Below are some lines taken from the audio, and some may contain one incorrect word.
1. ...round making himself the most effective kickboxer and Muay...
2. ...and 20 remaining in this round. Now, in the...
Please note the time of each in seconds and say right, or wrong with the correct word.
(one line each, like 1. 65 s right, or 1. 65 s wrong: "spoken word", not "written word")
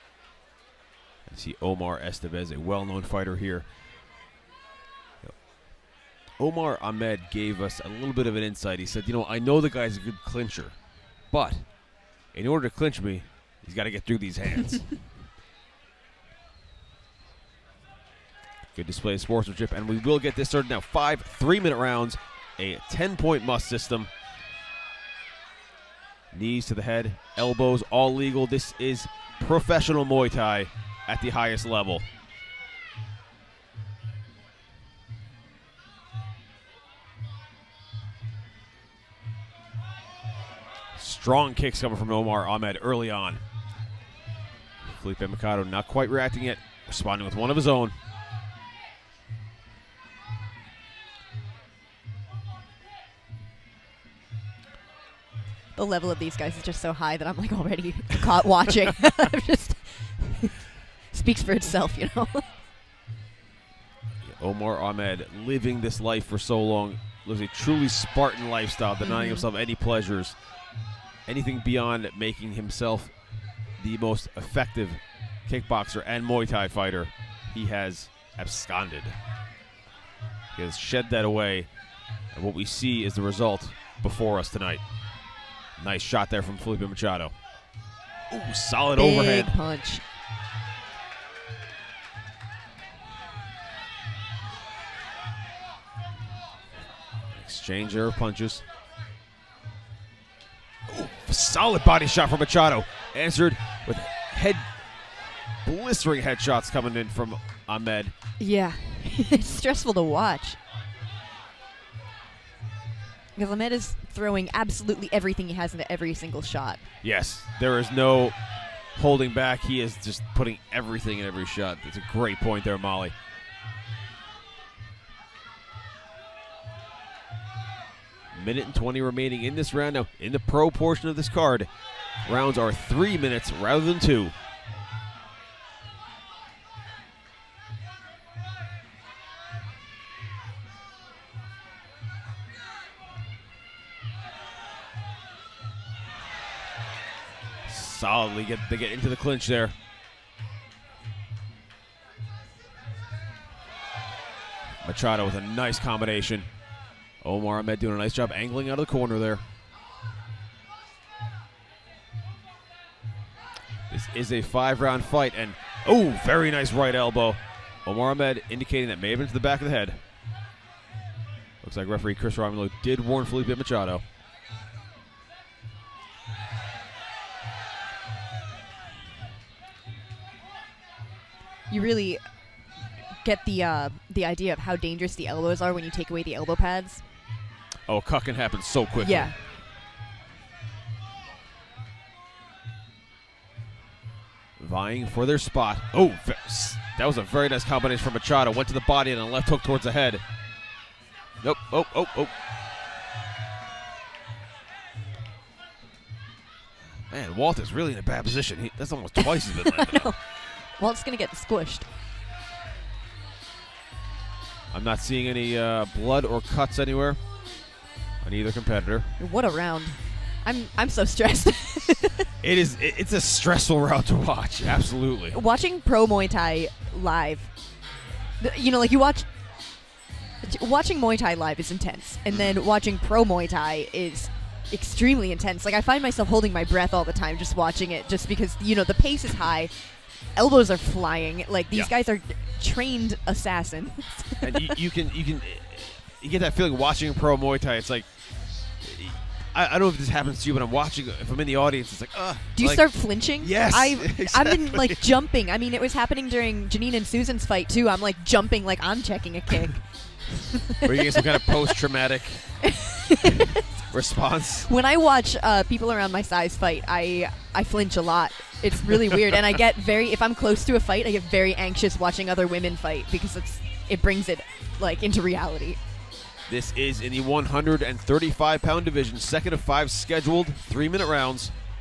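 1. 71 s wrong: "beyond", not "round"
2. 128 s right.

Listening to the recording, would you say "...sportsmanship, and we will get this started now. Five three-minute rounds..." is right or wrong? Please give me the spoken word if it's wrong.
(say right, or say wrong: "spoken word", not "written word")
right.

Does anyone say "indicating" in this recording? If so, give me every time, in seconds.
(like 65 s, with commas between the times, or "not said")
168 s.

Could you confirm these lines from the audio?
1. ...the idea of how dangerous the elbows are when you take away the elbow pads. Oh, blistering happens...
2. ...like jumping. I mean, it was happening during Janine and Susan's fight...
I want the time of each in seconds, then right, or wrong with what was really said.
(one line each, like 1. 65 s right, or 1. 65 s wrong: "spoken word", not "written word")
1. 184 s wrong: "cucking", not "blistering"
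2. 254 s right.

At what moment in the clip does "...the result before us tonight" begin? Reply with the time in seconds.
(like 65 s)
83 s.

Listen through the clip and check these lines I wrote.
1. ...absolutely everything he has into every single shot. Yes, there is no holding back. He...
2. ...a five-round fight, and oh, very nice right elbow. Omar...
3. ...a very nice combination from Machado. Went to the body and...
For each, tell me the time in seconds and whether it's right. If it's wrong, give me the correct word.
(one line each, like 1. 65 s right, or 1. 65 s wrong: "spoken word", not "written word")
1. 114 s right
2. 164 s right
3. 197 s right.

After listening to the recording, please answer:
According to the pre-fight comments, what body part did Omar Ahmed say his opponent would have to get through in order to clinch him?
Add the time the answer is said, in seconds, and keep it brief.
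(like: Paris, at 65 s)
hands, at 14 s.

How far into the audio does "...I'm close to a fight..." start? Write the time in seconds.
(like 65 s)
270 s.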